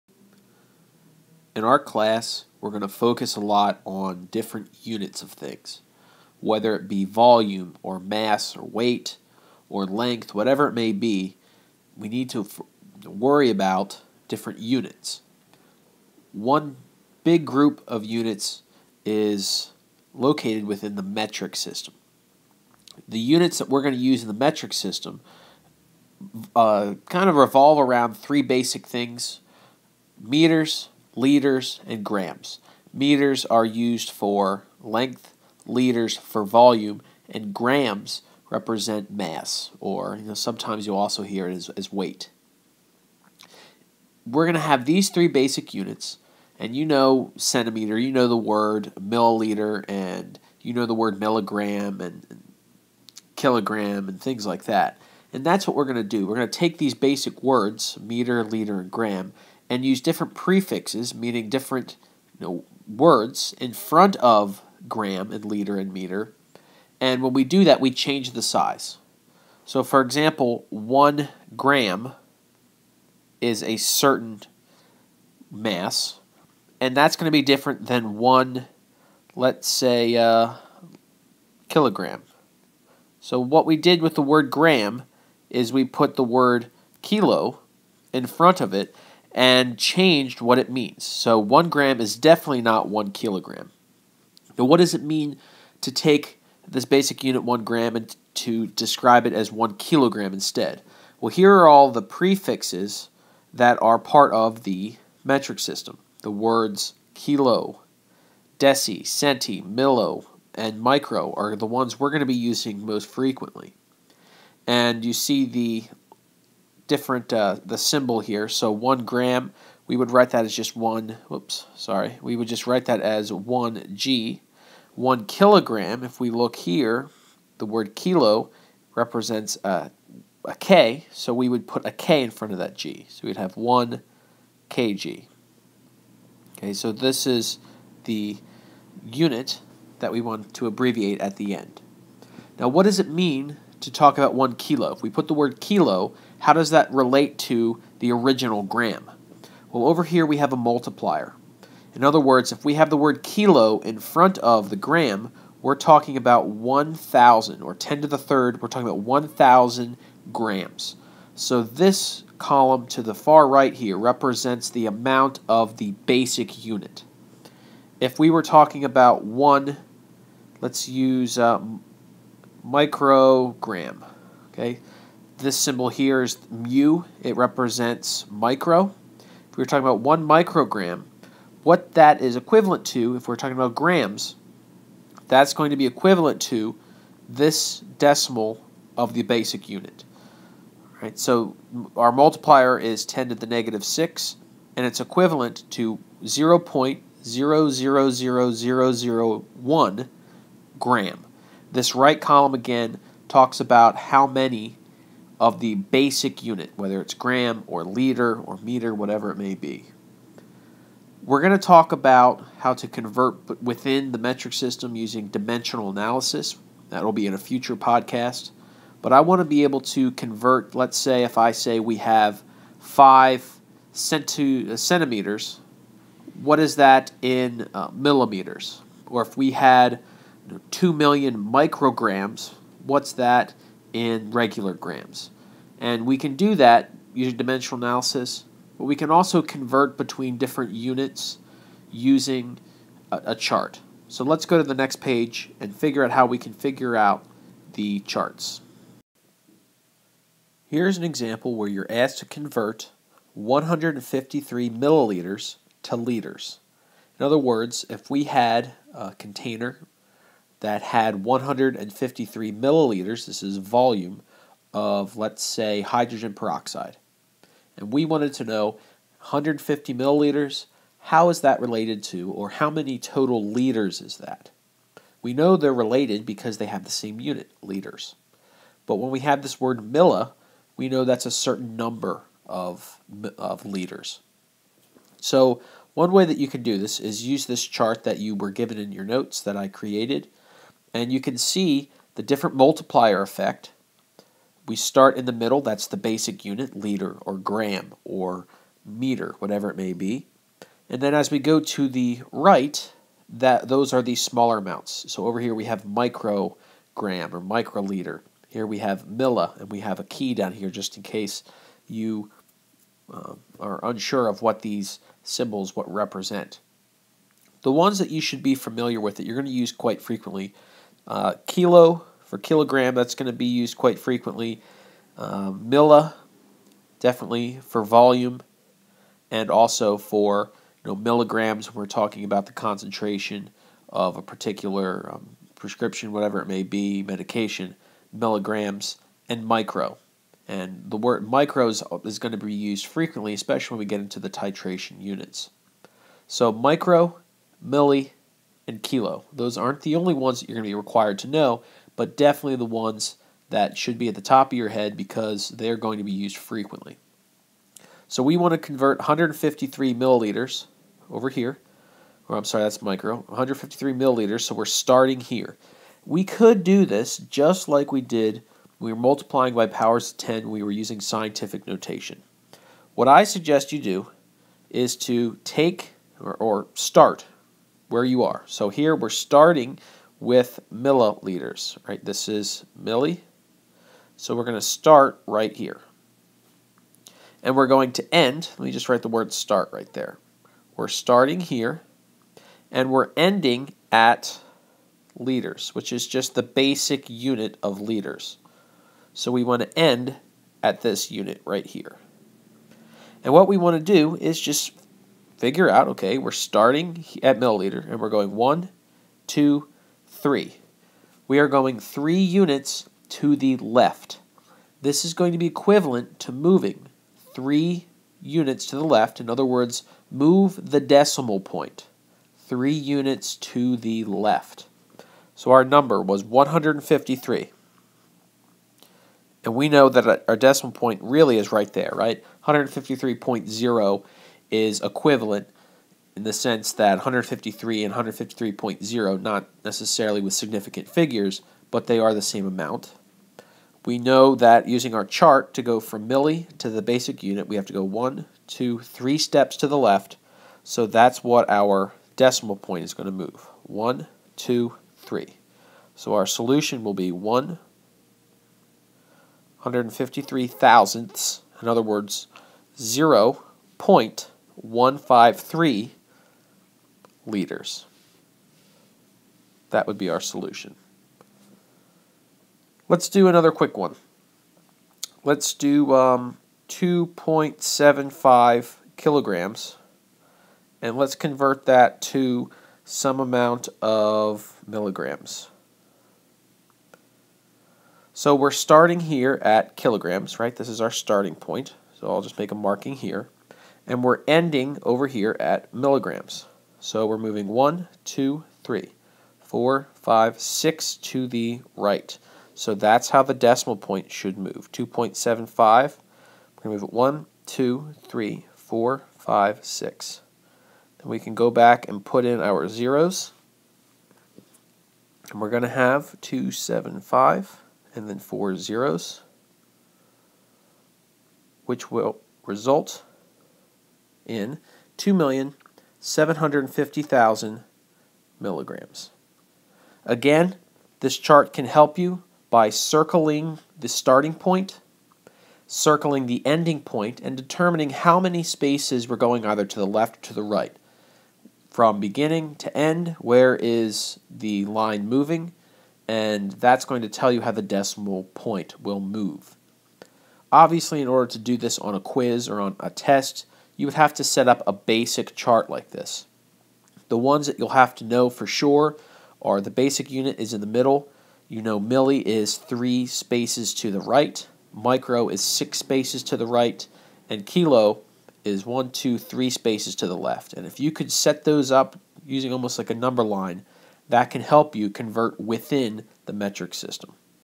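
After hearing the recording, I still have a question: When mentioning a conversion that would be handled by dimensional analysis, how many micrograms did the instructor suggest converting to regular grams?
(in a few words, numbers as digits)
2 million.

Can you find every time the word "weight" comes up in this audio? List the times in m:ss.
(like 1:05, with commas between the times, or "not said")
0:08, 0:41.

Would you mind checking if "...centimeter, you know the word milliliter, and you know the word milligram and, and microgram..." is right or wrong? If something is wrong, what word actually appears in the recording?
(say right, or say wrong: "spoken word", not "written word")
wrong: "kilogram", not "microgram".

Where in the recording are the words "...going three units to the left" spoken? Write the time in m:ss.
6:51.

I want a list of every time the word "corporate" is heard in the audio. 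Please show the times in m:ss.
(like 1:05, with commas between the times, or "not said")
not said.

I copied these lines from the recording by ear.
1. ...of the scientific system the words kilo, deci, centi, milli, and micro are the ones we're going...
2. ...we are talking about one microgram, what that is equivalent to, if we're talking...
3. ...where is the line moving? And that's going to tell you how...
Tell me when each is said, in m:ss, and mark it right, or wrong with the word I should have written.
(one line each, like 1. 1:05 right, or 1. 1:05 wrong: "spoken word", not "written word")
1. 1:44 wrong: "metric", not "scientific"
2. 2:59 right
3. 9:03 right.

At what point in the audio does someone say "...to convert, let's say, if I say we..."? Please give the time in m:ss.
3:39.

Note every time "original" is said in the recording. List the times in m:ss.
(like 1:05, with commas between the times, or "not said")
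2:28.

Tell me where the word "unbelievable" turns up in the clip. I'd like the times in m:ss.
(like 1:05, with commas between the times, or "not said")
not said.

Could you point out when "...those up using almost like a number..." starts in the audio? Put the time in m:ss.
9:31.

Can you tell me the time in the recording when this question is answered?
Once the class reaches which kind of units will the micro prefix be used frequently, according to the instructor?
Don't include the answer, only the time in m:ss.
5:44.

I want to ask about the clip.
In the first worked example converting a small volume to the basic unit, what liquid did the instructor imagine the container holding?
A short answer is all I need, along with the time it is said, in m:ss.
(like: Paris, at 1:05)
hydrogen peroxide, at 4:25.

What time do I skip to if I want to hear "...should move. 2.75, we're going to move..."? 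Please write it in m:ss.
8:24.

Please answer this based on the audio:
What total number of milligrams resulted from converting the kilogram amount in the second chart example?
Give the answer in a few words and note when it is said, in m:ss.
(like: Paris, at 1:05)
2,750,000, at 8:44.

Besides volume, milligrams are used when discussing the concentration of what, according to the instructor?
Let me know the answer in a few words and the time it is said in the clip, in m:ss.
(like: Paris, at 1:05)
prescription, at 5:35.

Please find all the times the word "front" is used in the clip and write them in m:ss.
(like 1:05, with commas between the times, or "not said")
1:03, 1:28, 2:12, 2:33.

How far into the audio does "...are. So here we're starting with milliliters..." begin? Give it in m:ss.
6:18.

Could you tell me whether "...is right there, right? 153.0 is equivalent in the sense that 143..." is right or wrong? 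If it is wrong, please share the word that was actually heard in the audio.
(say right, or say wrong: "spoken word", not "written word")
wrong: "153", not "143".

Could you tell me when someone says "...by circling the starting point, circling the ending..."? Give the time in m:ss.
8:52.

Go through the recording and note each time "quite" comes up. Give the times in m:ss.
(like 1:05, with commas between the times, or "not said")
5:19, 5:23.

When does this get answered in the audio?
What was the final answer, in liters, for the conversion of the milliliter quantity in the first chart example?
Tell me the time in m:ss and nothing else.
7:42.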